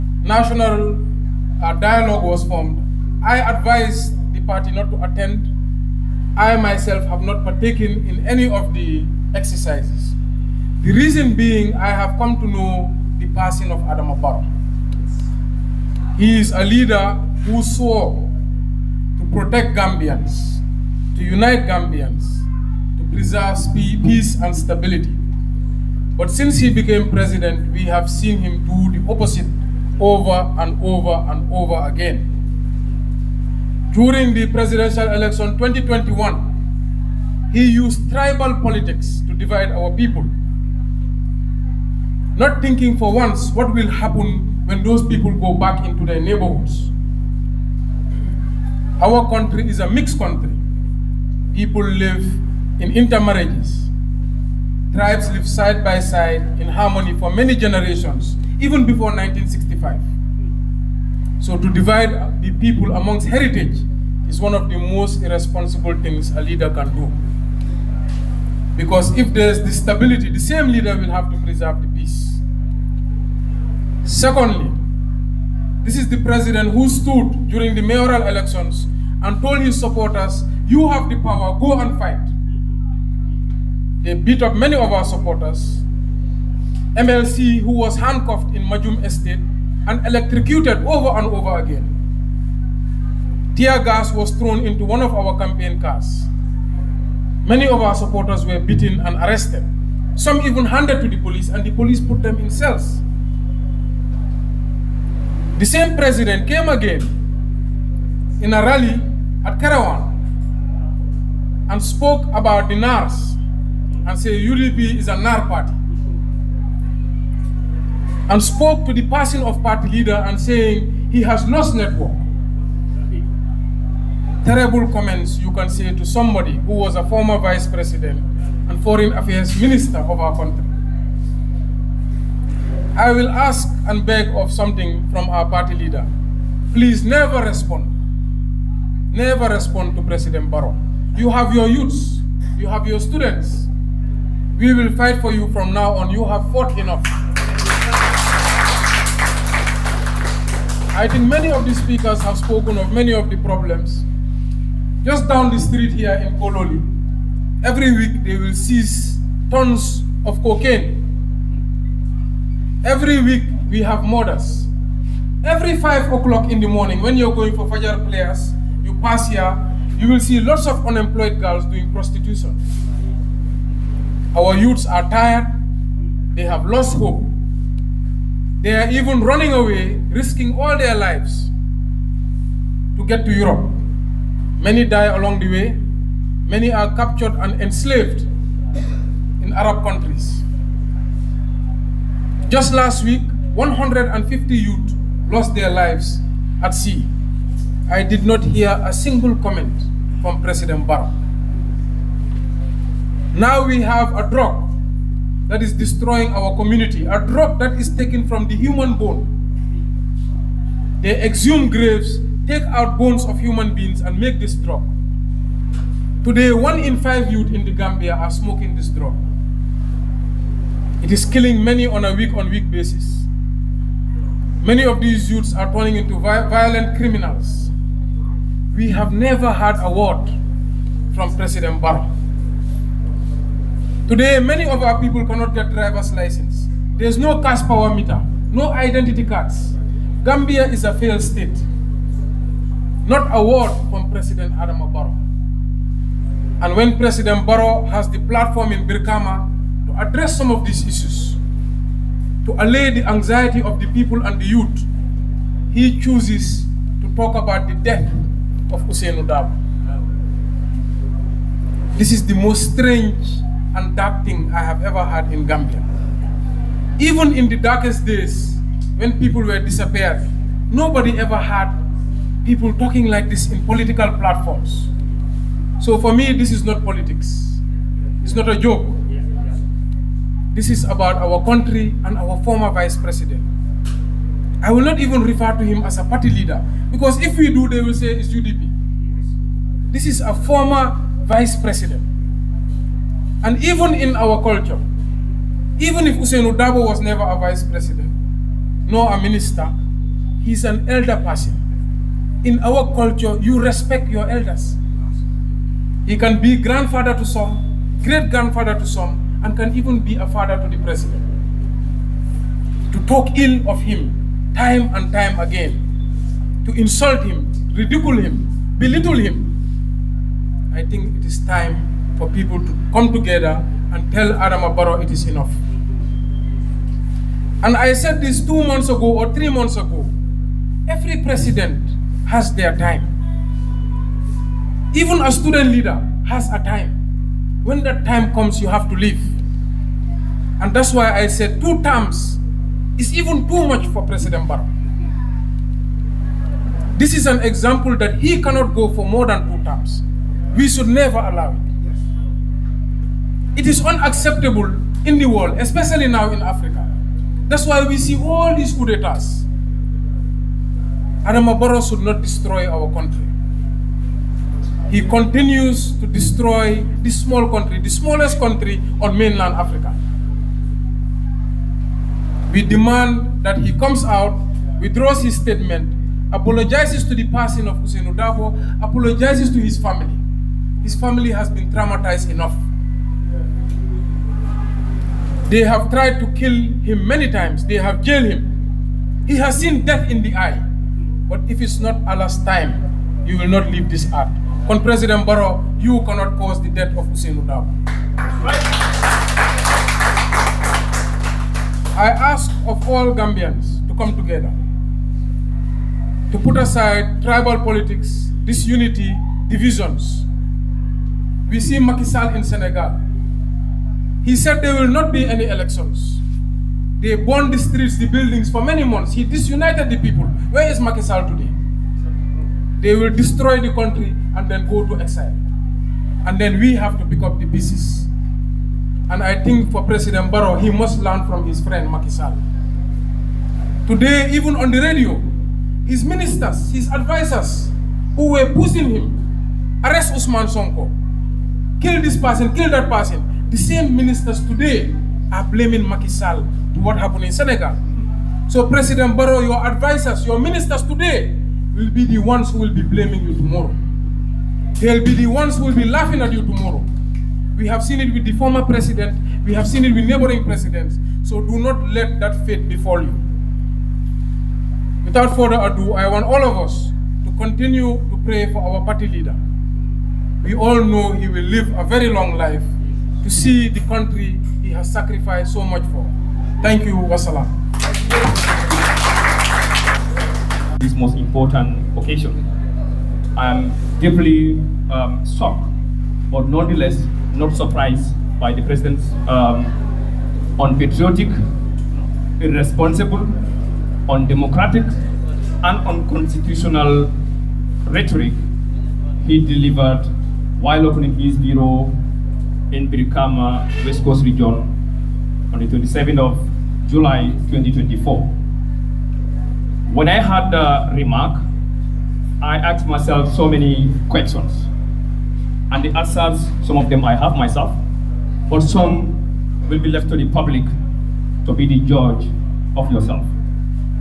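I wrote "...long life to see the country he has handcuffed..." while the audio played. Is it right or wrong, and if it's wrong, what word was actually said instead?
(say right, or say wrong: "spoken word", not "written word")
wrong: "sacrificed", not "handcuffed".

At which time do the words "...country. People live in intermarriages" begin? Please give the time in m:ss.
0:50.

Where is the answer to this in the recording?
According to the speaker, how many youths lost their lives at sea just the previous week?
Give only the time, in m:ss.
3:13.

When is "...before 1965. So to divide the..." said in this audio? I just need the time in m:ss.
0:58.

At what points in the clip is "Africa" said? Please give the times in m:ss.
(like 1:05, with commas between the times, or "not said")
5:56, 6:09.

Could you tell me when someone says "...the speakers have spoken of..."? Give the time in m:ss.
2:31.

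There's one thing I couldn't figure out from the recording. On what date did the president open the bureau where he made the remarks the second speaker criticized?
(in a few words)
27 July 2024.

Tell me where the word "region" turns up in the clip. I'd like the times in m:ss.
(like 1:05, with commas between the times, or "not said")
8:24.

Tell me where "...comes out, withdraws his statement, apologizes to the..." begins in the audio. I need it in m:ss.
6:13.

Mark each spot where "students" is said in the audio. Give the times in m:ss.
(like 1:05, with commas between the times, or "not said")
2:23, 5:35.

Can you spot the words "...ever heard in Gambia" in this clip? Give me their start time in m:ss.
4:24.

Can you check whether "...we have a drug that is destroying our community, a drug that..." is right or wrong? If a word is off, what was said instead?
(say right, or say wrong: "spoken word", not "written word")
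right.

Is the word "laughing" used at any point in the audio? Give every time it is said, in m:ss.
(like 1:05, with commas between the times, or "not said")
7:35.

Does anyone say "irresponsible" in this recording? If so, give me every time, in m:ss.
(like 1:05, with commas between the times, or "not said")
1:05, 8:12.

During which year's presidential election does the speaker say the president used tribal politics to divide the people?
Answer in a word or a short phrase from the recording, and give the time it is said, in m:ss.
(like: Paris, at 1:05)
2021, at 0:35.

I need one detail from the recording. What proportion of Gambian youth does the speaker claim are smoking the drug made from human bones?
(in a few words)
one in five.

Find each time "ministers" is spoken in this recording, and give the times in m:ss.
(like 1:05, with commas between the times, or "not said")
2:09, 4:59, 7:16, 7:23, 7:30.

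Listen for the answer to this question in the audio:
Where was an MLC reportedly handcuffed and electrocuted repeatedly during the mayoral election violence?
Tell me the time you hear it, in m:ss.
1:28.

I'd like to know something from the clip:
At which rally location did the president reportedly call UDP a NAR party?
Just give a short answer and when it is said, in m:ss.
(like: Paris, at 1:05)
Kerewan, at 1:49.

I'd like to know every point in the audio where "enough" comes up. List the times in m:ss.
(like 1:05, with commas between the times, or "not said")
2:26, 5:25, 6:22.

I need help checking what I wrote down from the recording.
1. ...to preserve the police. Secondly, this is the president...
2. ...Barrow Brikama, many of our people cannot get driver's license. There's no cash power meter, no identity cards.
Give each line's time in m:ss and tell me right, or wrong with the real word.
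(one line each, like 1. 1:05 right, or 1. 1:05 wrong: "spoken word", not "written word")
1. 1:11 wrong: "peace", not "police"
2. 3:51 wrong: "Today", not "Brikama".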